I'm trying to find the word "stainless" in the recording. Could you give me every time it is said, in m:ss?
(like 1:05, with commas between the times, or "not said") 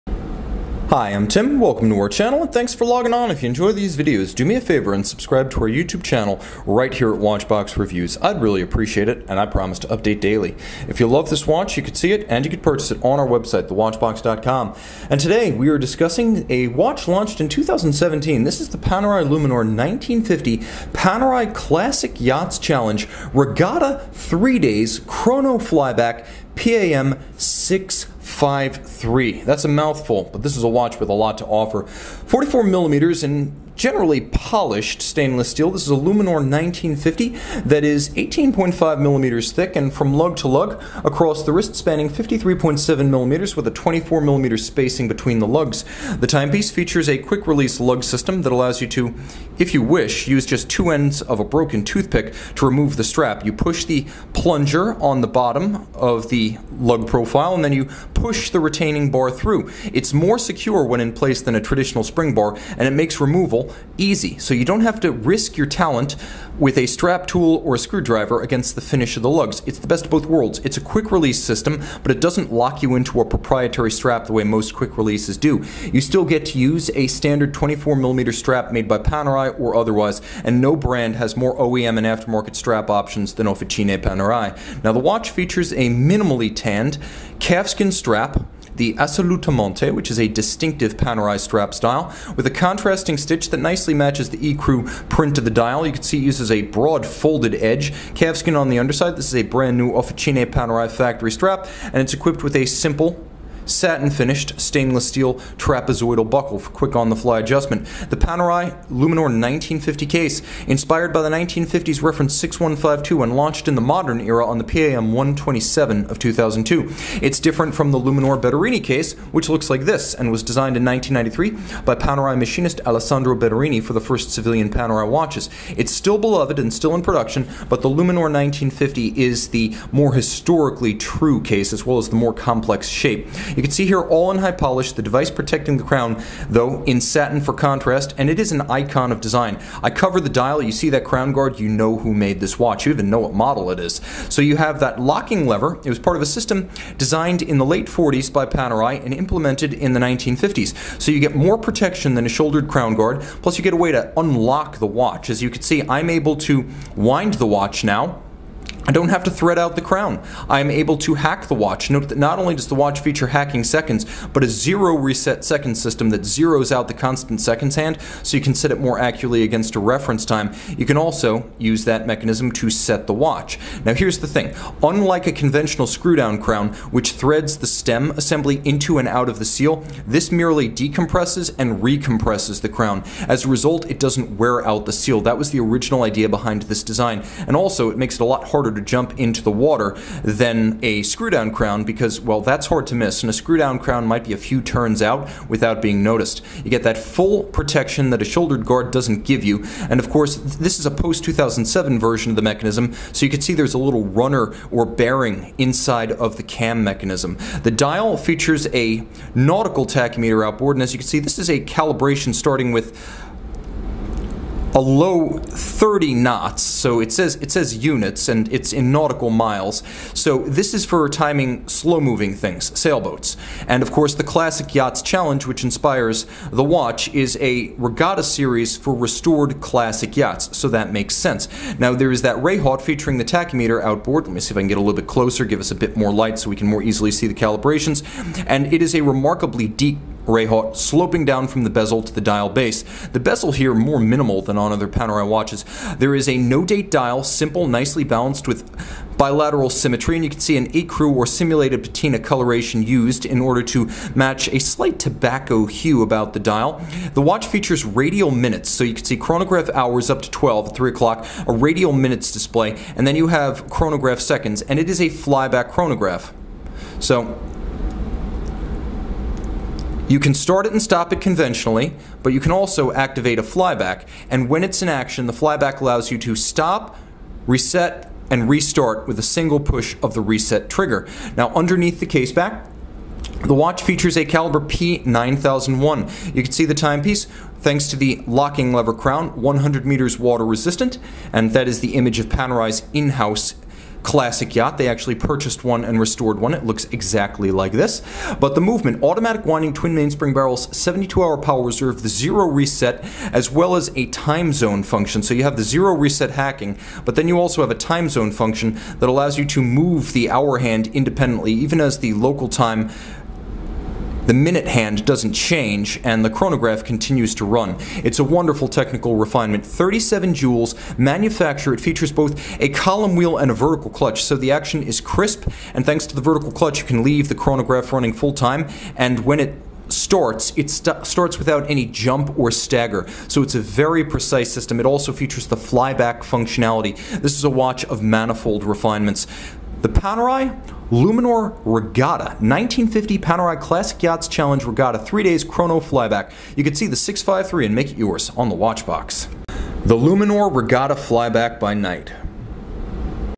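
0:35, 1:44.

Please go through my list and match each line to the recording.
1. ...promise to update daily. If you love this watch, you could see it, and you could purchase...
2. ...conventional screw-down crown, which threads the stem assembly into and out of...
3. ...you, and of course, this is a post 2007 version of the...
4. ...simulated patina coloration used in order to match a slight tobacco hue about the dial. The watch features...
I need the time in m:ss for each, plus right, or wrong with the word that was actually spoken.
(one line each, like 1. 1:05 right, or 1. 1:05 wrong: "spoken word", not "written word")
1. 0:09 right
2. 2:55 right
3. 3:19 right
4. 4:11 right.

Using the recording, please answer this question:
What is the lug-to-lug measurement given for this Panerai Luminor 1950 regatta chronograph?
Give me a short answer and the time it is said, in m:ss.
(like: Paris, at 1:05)
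53.7 millimeters, at 0:42.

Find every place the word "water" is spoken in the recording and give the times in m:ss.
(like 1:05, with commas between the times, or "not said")
3:09, 4:50.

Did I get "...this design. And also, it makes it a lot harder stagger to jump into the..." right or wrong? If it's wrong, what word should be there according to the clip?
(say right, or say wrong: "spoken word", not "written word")
wrong: "harder", not "stagger".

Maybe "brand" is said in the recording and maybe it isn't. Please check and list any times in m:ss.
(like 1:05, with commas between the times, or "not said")
1:20, 1:39.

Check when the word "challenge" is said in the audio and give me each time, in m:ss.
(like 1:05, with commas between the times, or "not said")
0:22, 3:45, 5:44.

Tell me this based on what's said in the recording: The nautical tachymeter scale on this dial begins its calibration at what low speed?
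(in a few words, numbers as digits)
30 knots.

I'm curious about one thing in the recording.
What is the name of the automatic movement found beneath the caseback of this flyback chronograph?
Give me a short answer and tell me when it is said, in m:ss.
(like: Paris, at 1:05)
P9001, at 4:44.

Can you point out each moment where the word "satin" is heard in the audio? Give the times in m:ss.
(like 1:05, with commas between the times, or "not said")
1:43, 2:16.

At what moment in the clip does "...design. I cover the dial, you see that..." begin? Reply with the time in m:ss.
2:19.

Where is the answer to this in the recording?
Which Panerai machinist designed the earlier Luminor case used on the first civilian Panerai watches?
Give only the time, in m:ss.
2:02.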